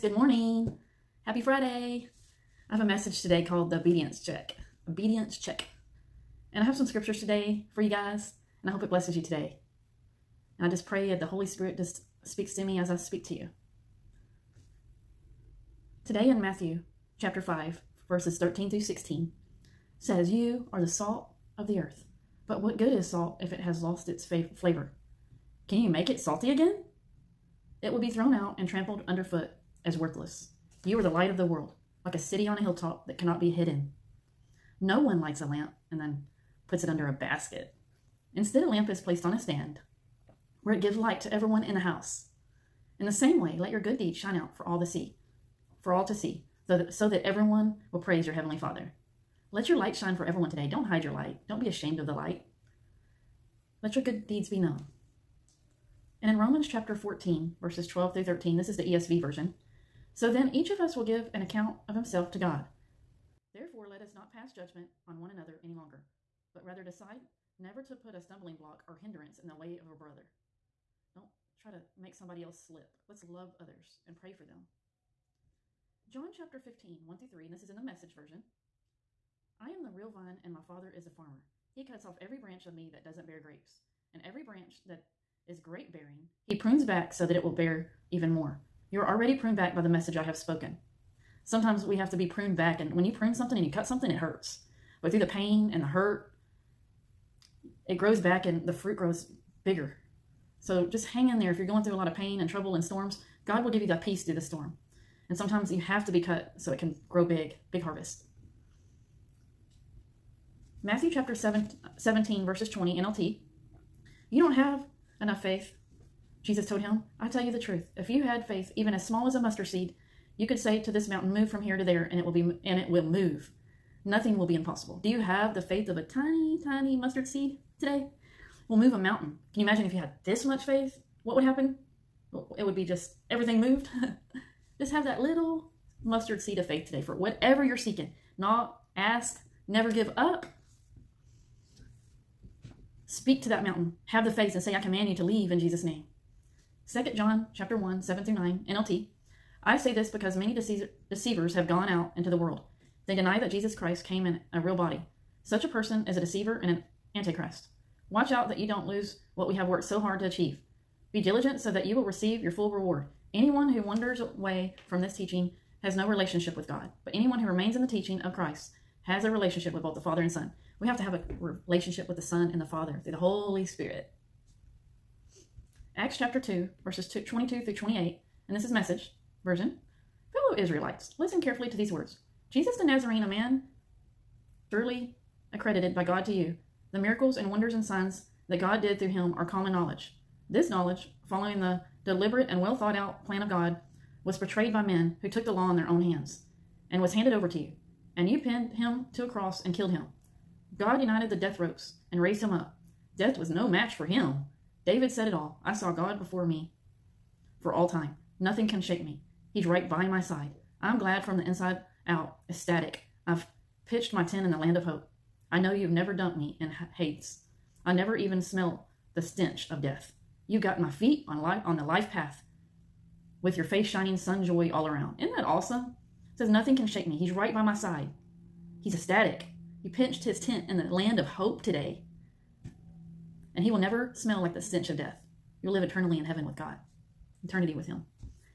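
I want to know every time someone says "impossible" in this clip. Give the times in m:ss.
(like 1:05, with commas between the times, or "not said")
2:04.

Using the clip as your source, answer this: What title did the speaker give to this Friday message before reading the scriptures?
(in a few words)
The obedience check.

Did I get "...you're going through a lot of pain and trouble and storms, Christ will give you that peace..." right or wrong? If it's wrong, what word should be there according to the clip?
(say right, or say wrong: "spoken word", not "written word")
wrong: "God", not "Christ".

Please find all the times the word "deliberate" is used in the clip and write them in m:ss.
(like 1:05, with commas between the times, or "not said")
3:12.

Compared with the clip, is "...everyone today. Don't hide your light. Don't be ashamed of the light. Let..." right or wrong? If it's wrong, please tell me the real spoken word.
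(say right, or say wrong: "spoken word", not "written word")
right.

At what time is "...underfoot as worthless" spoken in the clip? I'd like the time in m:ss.
0:29.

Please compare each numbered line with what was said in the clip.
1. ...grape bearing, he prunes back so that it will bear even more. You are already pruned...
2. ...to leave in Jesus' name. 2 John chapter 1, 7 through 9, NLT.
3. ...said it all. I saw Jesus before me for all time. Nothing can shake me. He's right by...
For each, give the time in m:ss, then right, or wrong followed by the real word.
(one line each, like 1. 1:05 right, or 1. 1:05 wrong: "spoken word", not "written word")
1. 1:25 right
2. 2:25 right
3. 3:25 wrong: "God", not "Jesus".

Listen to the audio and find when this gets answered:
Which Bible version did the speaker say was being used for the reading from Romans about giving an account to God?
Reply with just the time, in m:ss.
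0:58.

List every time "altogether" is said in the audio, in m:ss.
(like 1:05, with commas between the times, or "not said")
not said.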